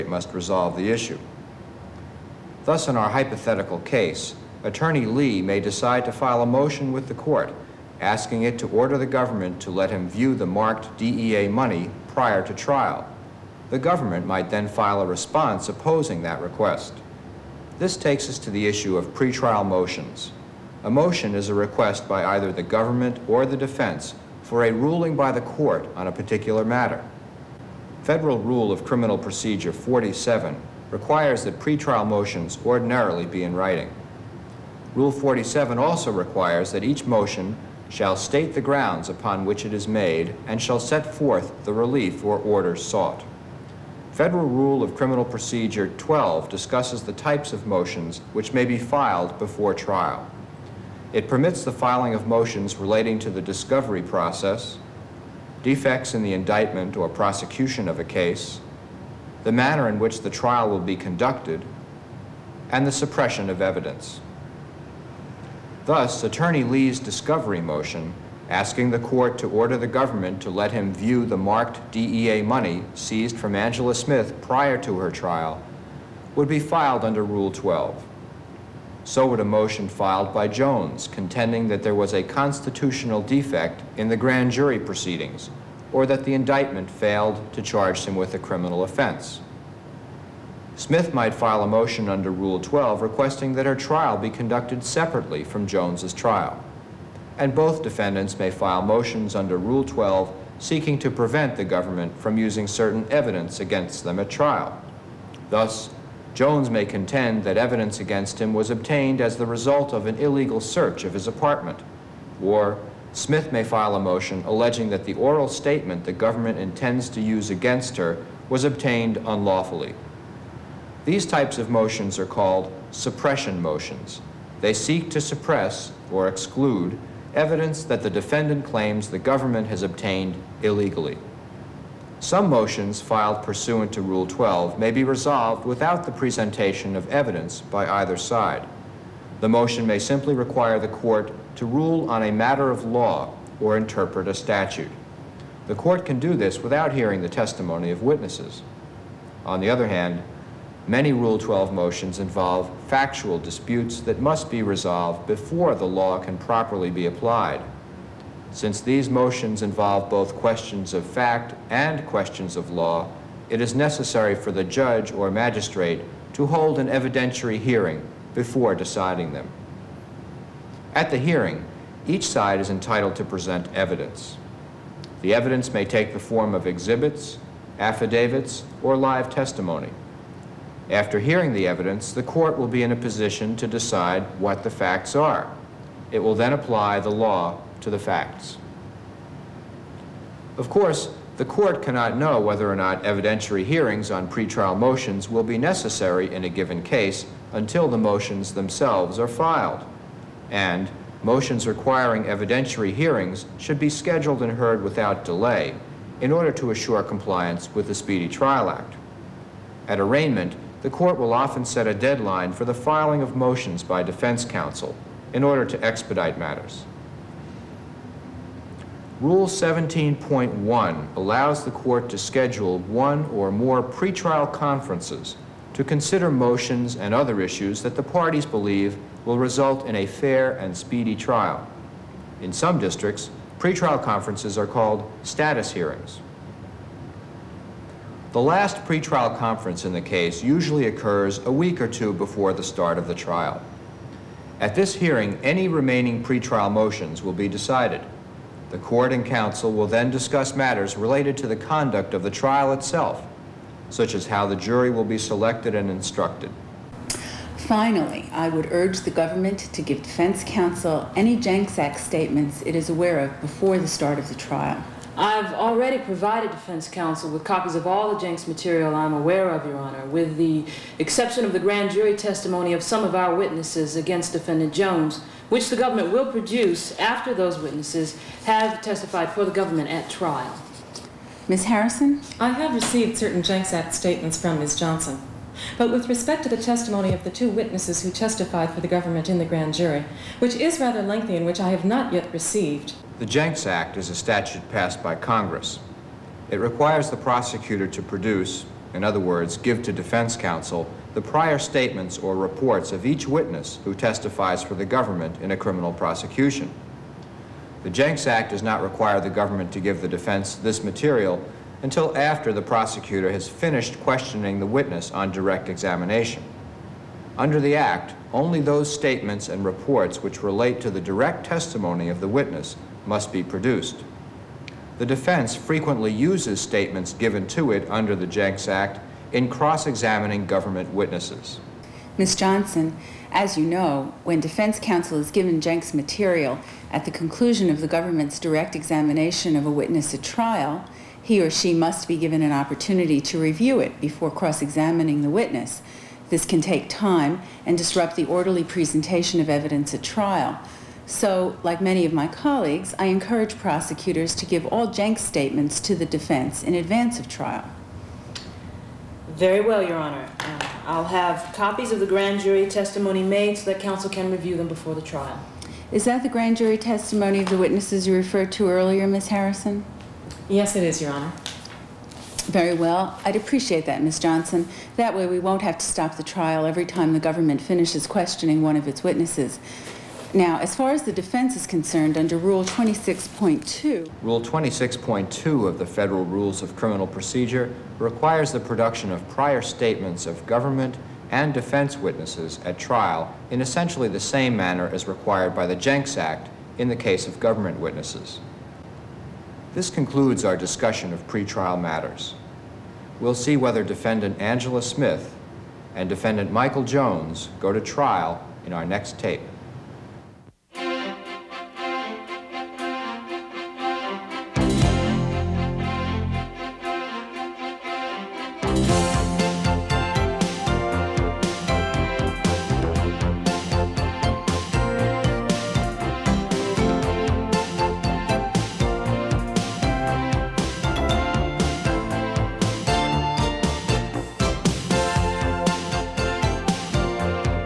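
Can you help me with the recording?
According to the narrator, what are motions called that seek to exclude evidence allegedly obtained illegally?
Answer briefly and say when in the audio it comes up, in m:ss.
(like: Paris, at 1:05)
suppression motions, at 2:02.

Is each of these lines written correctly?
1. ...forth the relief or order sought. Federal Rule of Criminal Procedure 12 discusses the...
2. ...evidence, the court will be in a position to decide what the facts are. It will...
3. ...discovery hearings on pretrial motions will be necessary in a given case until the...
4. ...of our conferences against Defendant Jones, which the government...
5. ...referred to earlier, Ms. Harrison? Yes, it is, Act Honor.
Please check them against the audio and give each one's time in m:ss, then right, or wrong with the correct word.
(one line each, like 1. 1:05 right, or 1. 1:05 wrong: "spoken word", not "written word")
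1. 0:41 right
2. 3:01 right
3. 3:13 wrong: "evidentiary", not "discovery"
4. 4:33 wrong: "witnesses", not "conferences"
5. 6:08 wrong: "Your", not "Act".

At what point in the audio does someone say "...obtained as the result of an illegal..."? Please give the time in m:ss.
1:48.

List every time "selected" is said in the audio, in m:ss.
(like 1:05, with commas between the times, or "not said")
4:15.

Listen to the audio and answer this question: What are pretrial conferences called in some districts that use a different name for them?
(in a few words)
status hearings.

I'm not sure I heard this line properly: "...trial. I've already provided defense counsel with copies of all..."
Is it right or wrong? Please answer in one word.
right.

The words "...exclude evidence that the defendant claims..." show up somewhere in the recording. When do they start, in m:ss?
2:06.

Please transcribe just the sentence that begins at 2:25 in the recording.
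The court can do this without hearing the testimony of witnesses.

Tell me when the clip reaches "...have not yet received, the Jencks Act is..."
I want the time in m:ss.
4:51.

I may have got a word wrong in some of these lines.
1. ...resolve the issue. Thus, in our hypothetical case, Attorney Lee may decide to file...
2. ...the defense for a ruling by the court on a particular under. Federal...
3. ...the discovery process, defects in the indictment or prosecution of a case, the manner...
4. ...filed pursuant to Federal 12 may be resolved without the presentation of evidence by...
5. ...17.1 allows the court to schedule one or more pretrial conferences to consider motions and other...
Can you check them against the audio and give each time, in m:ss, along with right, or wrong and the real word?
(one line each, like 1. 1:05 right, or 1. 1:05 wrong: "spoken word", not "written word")
1. 0:00 right
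2. 0:23 wrong: "matter", not "under"
3. 0:53 right
4. 2:13 wrong: "Rule", not "Federal"
5. 3:39 right.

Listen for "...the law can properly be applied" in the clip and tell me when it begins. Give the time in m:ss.
2:35.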